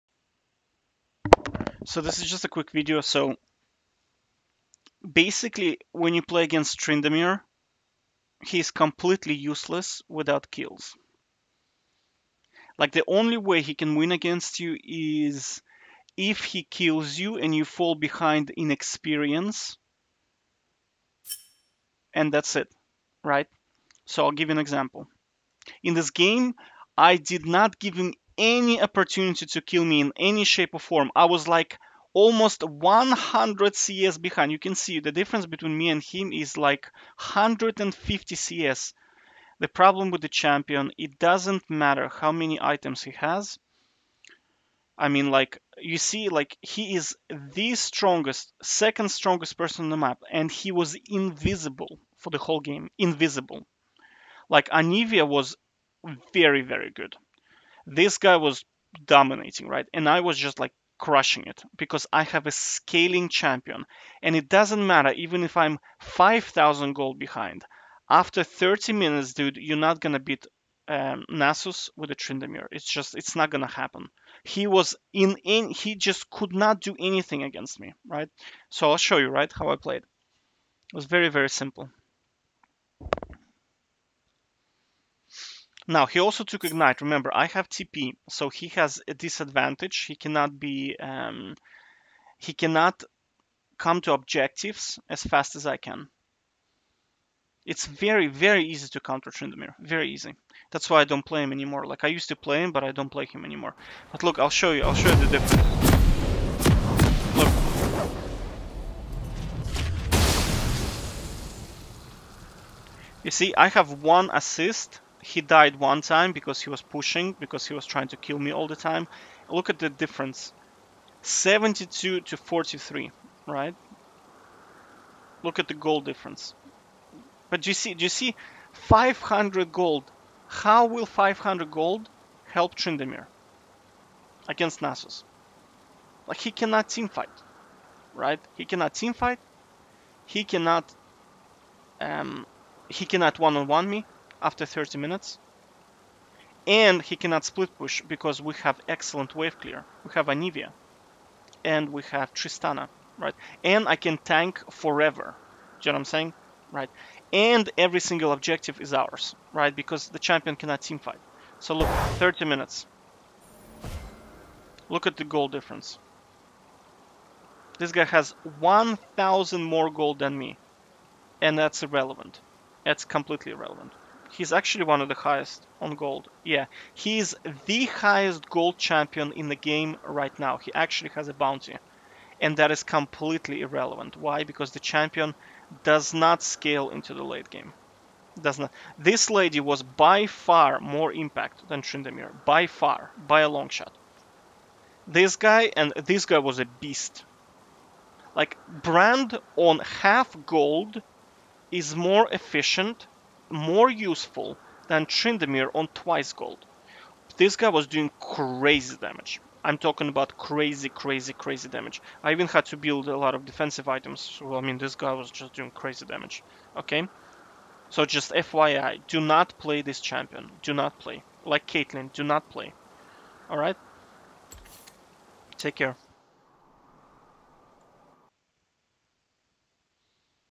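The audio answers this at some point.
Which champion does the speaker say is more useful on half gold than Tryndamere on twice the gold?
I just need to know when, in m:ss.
3:18.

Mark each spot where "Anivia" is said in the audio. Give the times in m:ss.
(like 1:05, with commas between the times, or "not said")
0:54, 2:30.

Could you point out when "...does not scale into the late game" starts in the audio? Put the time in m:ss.
3:05.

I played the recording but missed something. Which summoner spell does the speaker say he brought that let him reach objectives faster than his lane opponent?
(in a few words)
TP.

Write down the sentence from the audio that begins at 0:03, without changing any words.
So basically, when you play against Tryndamere, he's completely useless without kills.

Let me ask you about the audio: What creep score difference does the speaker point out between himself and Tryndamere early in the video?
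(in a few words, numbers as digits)
150 CS.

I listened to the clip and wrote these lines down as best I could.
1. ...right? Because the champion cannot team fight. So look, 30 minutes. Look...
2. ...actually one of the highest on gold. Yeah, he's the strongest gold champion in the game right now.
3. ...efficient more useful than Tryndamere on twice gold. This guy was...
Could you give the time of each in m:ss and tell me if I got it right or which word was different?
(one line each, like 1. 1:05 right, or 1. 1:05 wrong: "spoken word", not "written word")
1. 2:39 right
2. 2:54 wrong: "highest", not "strongest"
3. 3:22 right.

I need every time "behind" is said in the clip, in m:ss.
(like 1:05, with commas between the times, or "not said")
0:17, 0:34, 1:07.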